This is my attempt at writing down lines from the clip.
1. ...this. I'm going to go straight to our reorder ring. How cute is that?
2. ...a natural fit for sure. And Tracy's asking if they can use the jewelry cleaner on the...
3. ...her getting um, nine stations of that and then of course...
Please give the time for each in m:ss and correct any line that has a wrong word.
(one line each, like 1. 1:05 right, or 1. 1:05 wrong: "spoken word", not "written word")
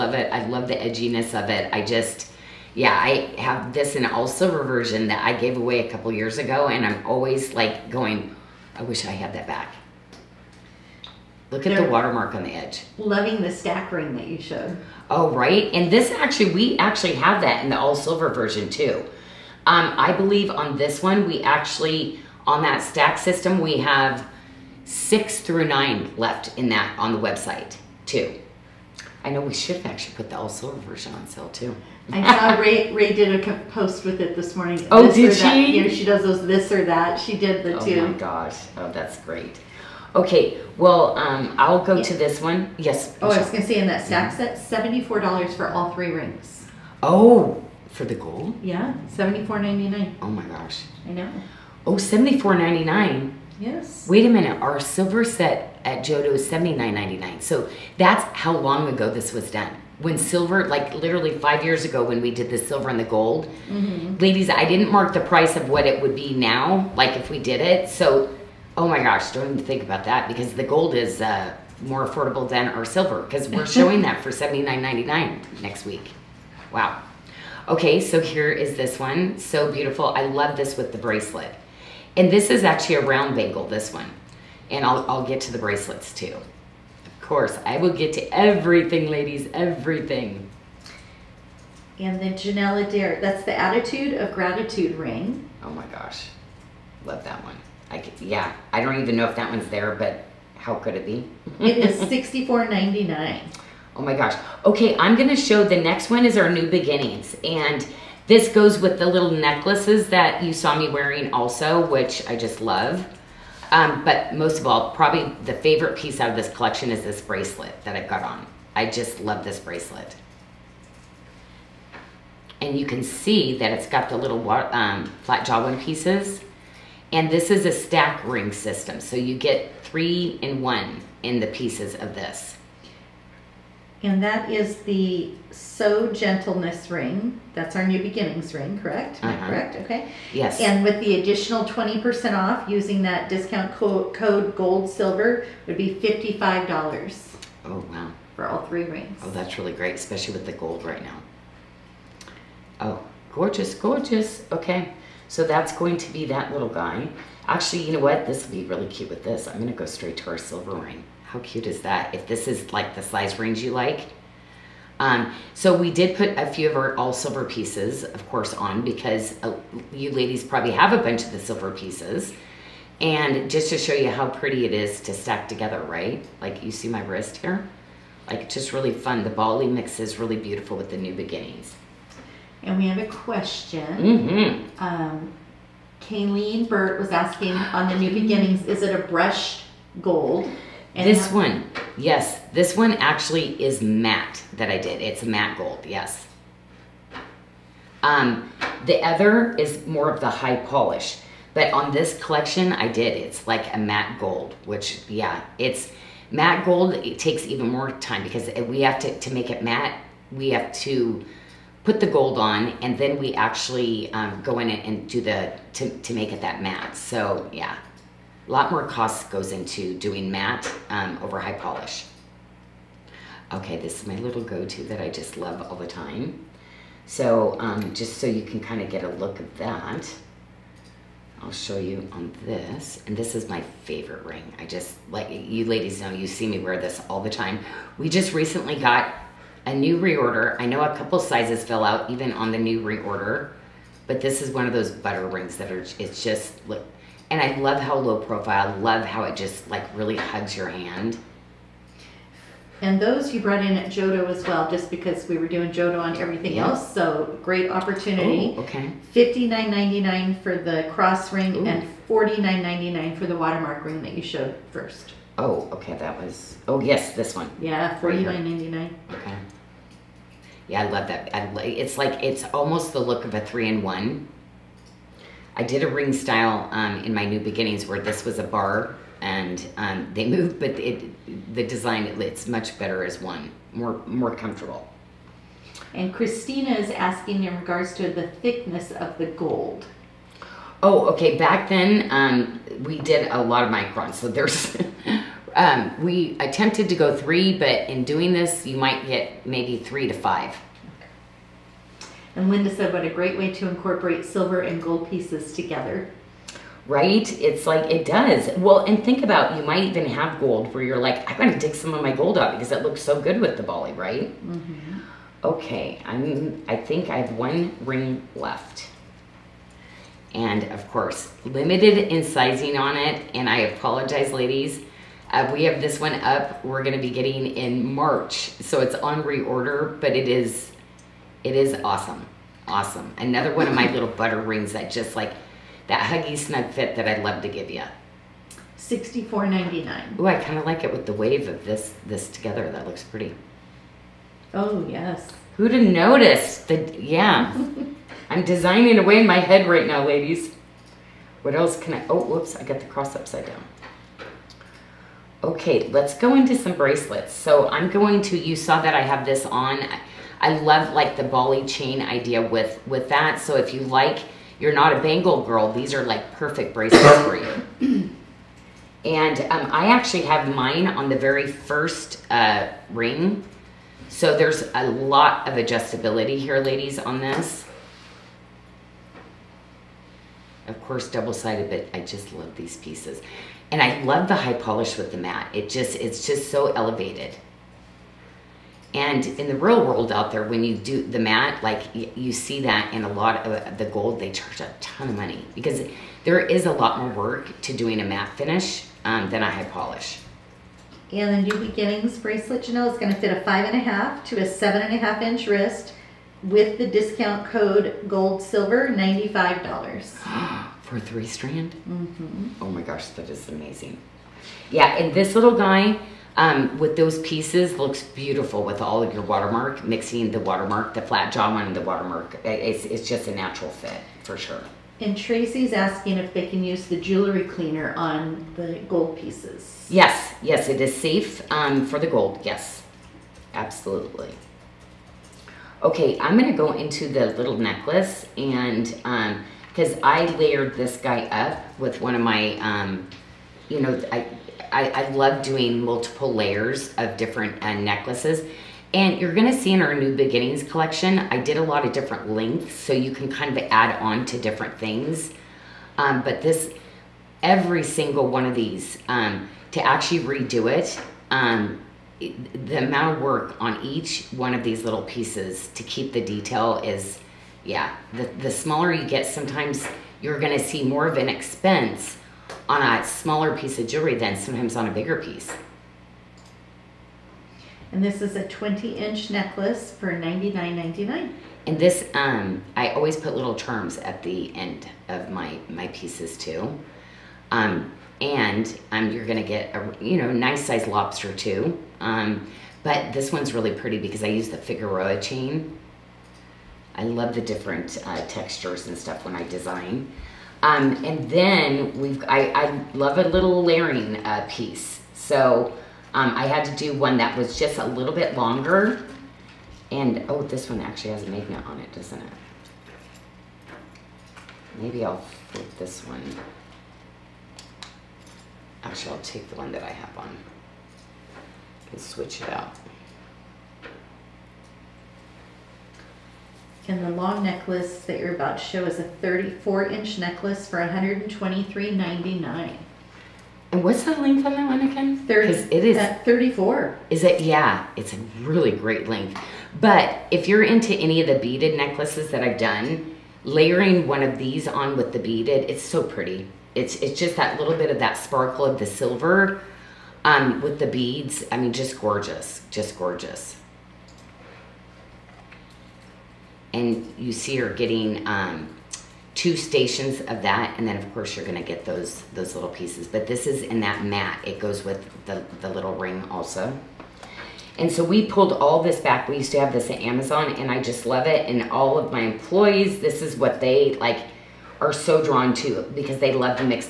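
1. 2:39 wrong: "silver", not "reorder"
2. 7:03 right
3. 9:17 wrong: "two", not "nine".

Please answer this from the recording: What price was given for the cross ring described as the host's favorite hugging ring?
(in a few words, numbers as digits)
$59.99.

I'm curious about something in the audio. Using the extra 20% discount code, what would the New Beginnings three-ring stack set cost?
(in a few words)
$55.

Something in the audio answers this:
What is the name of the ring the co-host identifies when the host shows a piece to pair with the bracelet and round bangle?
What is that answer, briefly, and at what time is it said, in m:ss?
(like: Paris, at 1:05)
Attitude of Gratitude, at 1:33.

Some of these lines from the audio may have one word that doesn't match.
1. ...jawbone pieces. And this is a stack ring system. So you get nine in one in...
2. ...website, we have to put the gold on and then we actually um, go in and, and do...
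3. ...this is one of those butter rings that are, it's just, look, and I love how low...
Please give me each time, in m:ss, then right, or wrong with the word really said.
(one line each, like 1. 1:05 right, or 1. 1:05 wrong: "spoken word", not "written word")
1. 2:05 wrong: "three", not "nine"
2. 3:29 wrong: "matte", not "website"
3. 4:04 right.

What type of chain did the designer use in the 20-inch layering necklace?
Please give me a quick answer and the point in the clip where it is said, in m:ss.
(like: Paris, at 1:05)
Figaro chain, at 8:14.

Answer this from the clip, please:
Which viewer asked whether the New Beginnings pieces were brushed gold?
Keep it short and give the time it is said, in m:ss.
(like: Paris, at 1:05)
Kayleen Burt, at 3:06.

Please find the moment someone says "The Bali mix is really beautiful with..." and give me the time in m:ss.
2:59.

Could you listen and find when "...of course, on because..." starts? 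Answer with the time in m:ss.
2:48.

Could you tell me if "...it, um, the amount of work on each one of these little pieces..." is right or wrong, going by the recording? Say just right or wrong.
right.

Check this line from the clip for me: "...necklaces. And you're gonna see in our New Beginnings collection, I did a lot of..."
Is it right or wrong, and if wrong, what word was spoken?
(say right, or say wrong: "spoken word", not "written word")
right.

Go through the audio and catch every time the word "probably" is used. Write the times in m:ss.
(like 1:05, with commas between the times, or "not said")
1:54, 2:50.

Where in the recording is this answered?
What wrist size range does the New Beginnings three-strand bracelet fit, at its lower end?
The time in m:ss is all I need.
6:43.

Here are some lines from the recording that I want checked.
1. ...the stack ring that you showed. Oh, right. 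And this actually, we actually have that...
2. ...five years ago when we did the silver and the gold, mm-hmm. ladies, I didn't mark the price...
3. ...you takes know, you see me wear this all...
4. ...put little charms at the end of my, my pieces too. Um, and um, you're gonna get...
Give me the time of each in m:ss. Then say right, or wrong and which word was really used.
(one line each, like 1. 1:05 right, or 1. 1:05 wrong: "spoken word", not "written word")
1. 0:13 right
2. 1:01 right
3. 3:55 wrong: "ladies", not "takes"
4. 8:03 right.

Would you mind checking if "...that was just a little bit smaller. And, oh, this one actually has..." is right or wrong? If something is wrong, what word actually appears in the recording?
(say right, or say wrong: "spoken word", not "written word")
wrong: "longer", not "smaller".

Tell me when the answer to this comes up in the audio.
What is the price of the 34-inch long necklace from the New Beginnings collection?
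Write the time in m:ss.
8:50.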